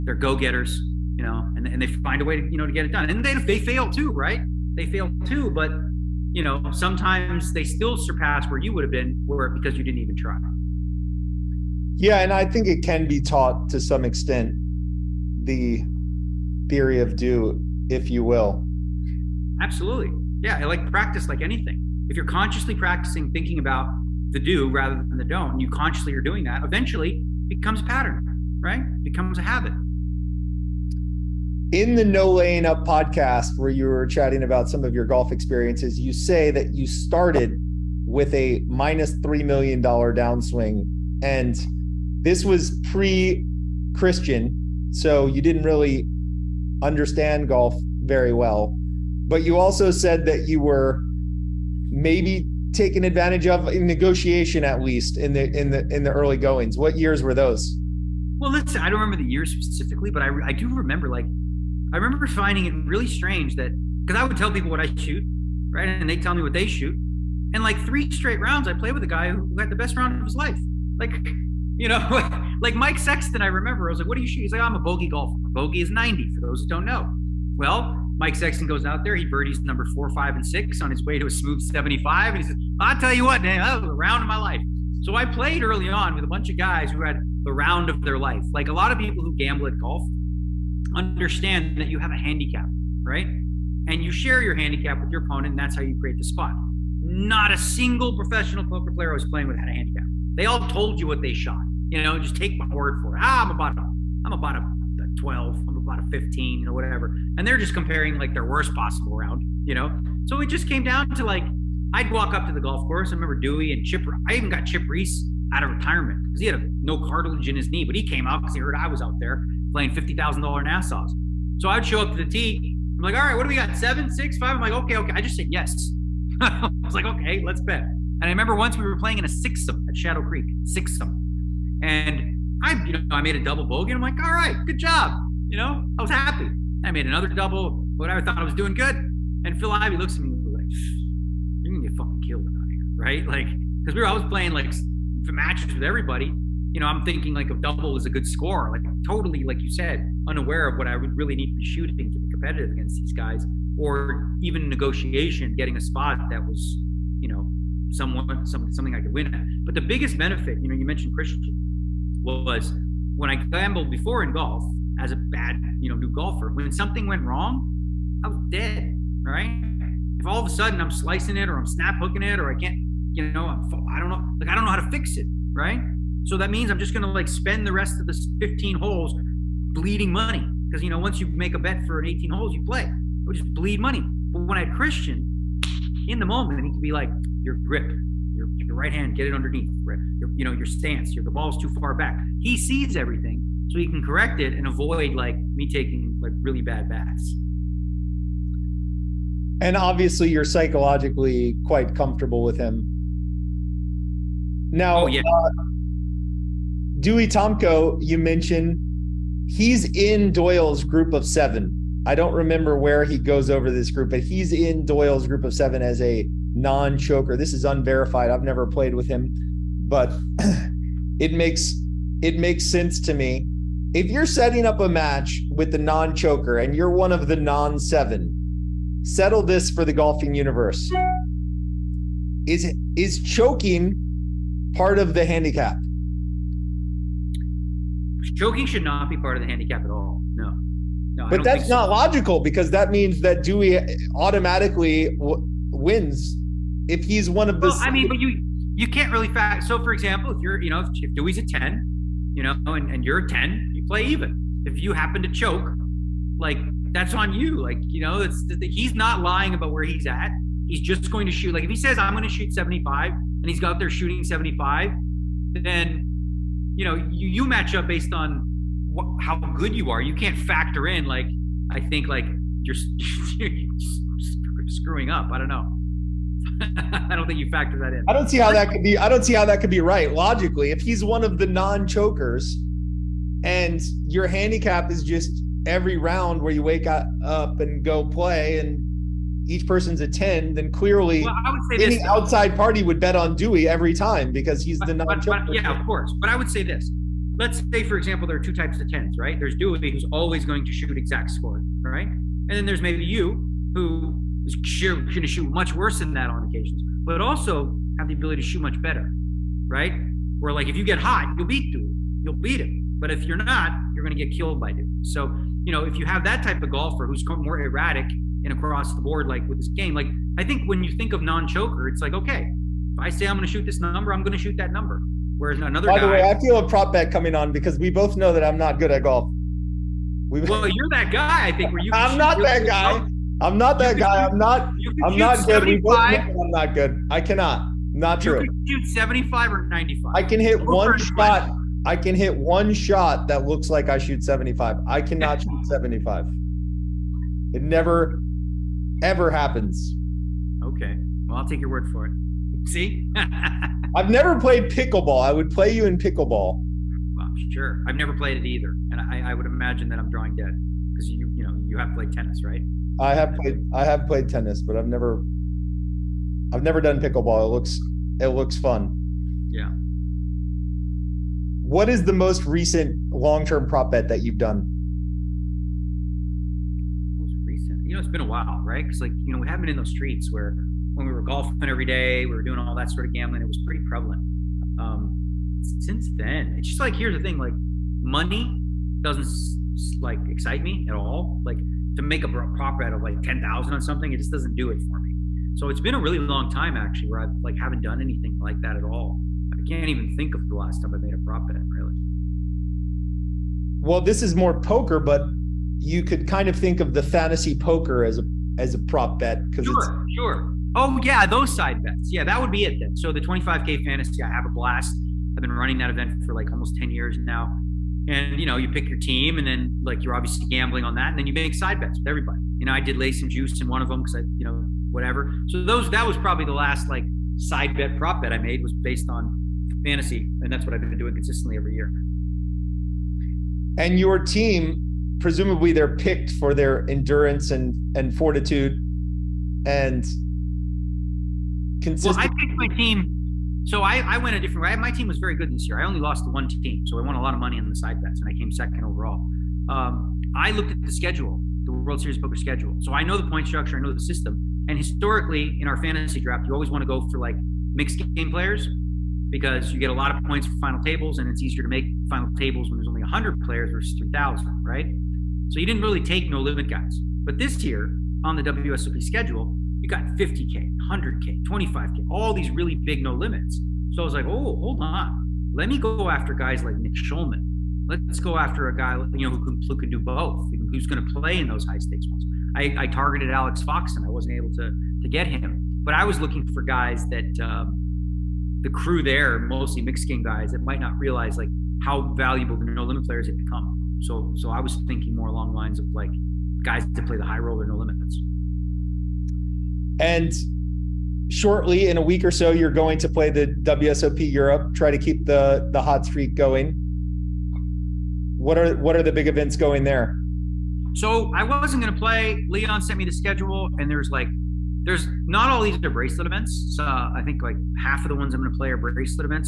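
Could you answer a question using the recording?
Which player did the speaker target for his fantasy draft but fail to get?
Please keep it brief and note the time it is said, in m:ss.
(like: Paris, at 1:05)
Alex Fox, at 8:03.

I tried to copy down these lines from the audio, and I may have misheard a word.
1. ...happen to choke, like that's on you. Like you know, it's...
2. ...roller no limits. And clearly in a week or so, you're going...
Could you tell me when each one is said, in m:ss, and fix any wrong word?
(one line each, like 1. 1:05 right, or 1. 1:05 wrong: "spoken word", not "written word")
1. 4:14 right
2. 8:17 wrong: "shortly", not "clearly".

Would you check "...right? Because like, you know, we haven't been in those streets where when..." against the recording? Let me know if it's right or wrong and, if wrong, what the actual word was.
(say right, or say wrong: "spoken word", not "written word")
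right.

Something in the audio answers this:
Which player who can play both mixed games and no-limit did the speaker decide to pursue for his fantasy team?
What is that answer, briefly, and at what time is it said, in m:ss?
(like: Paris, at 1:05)
Nick Schulman, at 7:56.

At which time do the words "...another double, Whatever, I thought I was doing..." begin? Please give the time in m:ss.
2:17.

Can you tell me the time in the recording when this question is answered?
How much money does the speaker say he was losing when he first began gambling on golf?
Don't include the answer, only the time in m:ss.
0:38.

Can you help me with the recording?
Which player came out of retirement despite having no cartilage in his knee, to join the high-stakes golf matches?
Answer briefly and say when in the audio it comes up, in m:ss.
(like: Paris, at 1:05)
Chip Reese, at 1:54.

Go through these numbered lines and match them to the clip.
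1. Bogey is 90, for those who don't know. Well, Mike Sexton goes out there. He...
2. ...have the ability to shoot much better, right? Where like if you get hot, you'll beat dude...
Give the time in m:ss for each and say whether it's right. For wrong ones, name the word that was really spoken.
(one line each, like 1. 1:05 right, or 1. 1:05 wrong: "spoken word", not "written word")
1. 1:15 right
2. 5:07 right.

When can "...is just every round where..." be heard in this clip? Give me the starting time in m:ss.
4:44.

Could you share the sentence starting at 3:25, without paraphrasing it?
uh, Dewey Tomko, you mentioned he's in Doyle's group of seven.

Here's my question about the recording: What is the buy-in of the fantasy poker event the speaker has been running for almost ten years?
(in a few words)
25k.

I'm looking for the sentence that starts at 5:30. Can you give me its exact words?
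We've, well, you're that guy, I think.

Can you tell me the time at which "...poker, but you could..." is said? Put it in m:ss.
6:44.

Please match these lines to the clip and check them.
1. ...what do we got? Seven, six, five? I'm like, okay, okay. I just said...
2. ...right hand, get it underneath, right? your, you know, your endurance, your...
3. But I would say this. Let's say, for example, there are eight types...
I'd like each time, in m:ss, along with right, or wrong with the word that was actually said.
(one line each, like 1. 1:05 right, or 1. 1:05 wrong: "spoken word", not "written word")
1. 2:03 right
2. 3:08 wrong: "stance", not "endurance"
3. 4:56 wrong: "two", not "eight".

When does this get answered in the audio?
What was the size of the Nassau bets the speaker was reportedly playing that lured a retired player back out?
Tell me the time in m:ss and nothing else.
1:59.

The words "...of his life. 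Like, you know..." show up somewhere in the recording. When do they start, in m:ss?
1:10.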